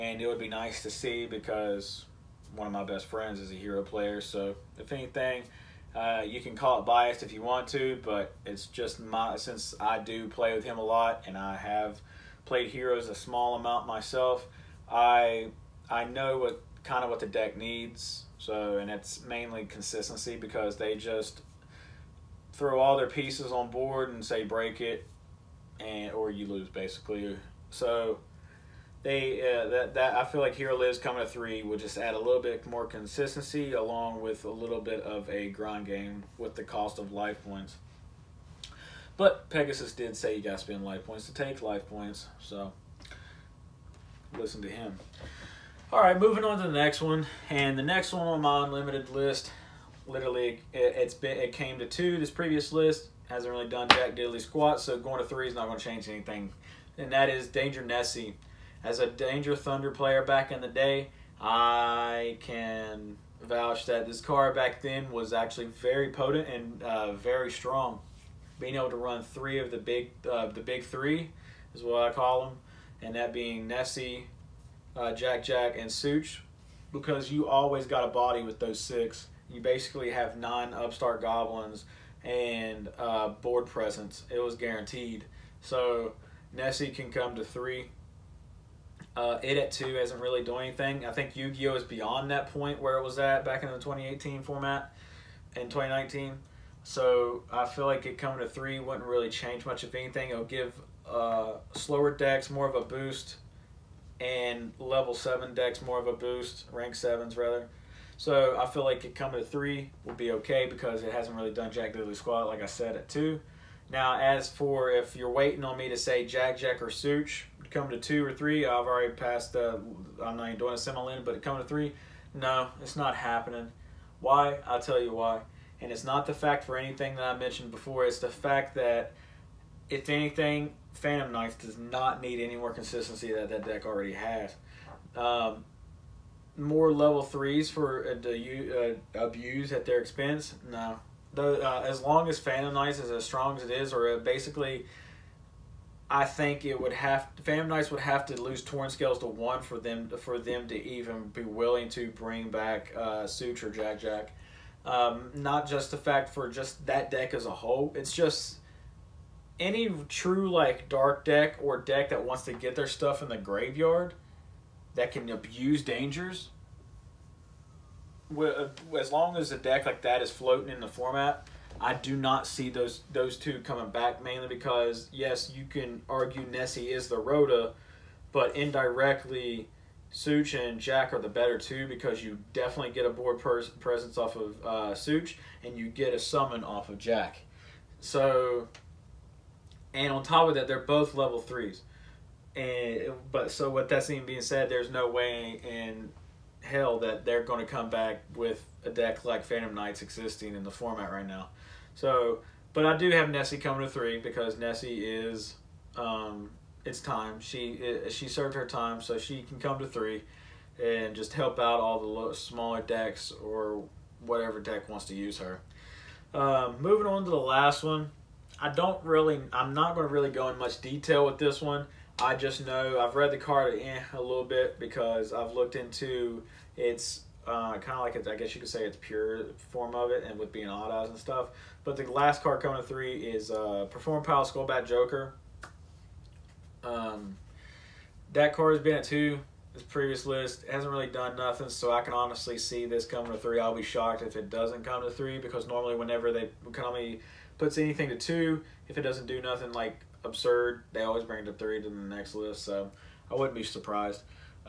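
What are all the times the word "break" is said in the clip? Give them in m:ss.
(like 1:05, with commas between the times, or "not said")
0:24.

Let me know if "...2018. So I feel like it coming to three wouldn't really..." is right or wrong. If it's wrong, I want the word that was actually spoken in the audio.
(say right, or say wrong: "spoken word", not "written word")
wrong: "2019", not "2018".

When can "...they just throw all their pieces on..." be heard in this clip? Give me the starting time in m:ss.
0:20.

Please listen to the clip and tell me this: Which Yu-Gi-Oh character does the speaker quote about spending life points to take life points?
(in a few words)
Pegasus.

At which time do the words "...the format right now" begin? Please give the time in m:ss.
3:20.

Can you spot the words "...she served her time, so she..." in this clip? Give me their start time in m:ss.
3:28.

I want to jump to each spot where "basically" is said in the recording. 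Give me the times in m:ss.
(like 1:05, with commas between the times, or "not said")
0:26, 1:19, 2:24.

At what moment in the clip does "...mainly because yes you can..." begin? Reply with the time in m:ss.
2:54.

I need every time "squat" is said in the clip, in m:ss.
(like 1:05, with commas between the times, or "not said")
0:54, 1:52.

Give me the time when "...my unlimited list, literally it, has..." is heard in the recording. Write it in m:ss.
0:48.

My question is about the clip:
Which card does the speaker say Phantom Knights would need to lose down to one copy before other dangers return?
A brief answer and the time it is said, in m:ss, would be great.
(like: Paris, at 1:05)
Torn Scales, at 2:28.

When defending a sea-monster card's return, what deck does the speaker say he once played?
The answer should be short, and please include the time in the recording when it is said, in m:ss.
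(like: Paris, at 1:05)
Danger Thunder, at 0:59.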